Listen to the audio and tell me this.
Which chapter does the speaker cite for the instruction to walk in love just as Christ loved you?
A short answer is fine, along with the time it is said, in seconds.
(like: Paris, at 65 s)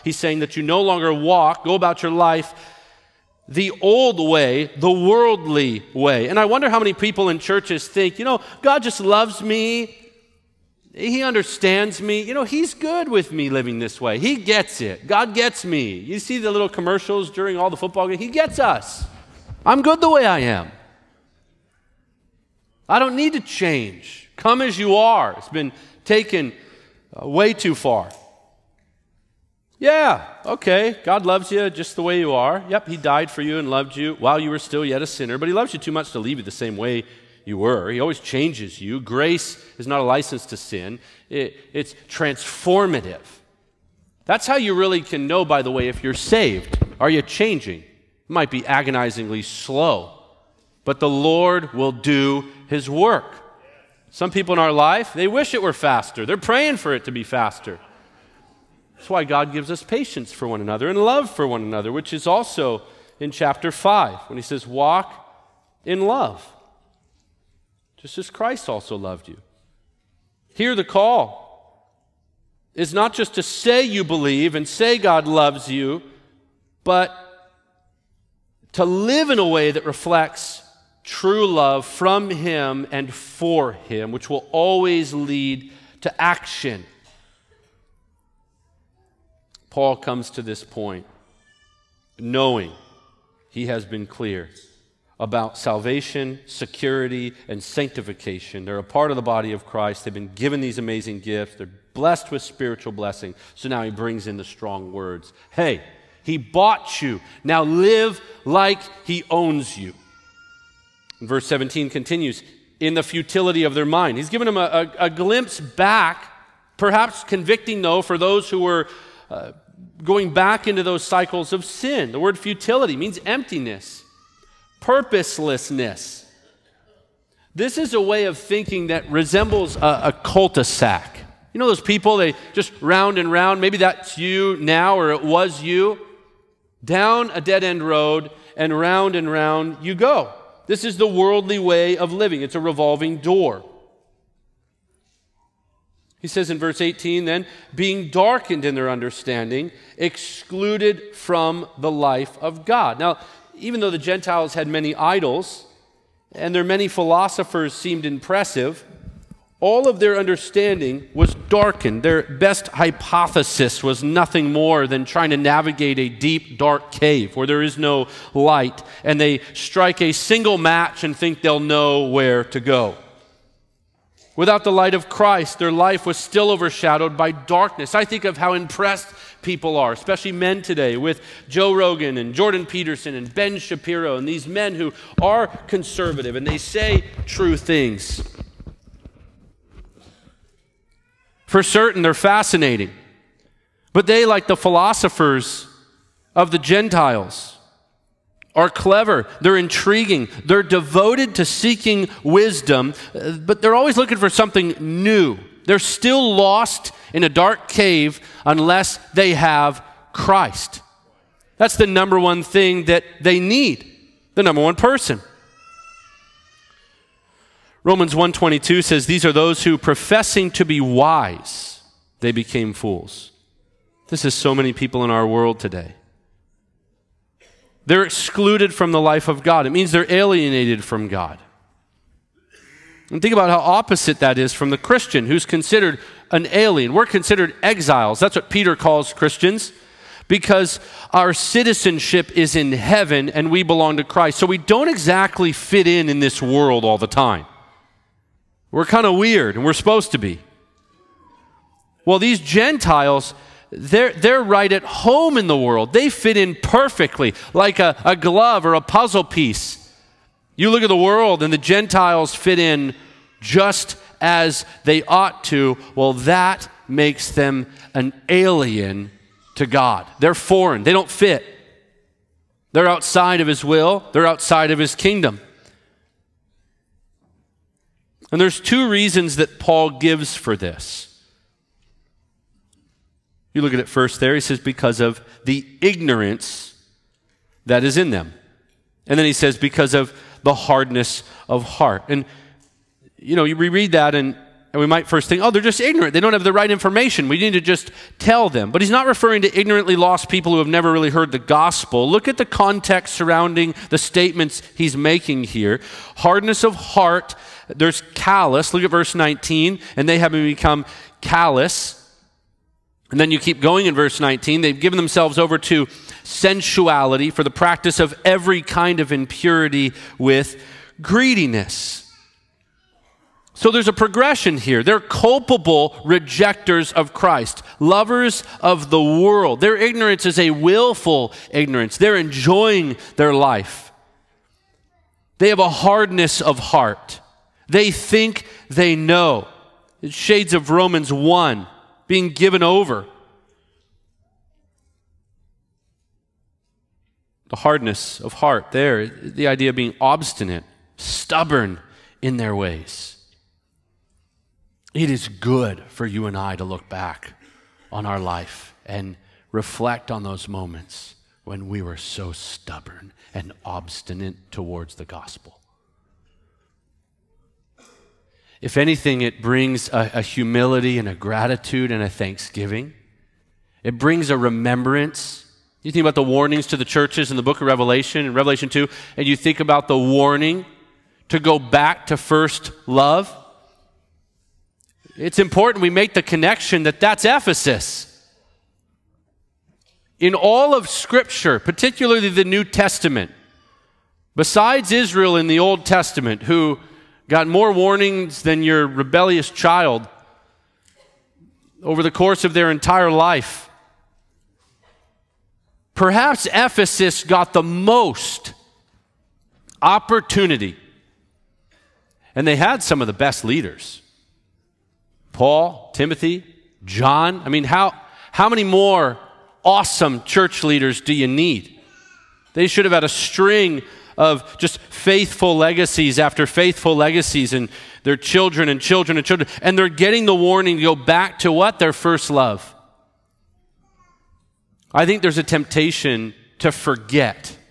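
Chapter 5, at 63 s.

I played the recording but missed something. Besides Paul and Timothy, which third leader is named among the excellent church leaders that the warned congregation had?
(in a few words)
John.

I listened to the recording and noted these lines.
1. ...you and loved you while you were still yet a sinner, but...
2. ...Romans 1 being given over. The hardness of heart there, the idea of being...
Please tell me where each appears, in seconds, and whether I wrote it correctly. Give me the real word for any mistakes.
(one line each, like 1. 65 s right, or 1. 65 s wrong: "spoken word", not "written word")
1. 33 s right
2. 340 s right.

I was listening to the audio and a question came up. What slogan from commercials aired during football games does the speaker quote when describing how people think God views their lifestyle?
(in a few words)
He gets us.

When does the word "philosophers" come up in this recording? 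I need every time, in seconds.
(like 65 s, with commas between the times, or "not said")
156 s, 194 s.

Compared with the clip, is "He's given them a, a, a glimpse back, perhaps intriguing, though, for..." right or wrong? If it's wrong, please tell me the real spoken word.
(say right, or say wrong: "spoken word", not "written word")
wrong: "convicting", not "intriguing".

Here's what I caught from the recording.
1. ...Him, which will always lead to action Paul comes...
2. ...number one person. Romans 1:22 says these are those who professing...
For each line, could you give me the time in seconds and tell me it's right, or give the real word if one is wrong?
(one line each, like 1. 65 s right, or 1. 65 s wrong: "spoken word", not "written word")
1. 83 s right
2. 214 s right.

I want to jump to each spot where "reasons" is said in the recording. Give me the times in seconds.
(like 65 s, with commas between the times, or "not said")
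278 s.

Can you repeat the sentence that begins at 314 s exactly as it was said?
They've given themselves over to sensuality for the practice of every kind of impurity with greediness.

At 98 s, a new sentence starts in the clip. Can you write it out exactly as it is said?
They're a part of the body of Christ.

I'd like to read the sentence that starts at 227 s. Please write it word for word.
They're excluded from the life of God.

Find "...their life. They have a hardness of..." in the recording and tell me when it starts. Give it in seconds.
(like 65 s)
333 s.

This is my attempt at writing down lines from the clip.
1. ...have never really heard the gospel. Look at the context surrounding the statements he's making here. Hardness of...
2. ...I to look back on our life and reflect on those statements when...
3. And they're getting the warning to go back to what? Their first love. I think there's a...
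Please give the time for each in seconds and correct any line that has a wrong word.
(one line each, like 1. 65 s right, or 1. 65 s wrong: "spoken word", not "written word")
1. 300 s right
2. 356 s wrong: "moments", not "statements"
3. 429 s right.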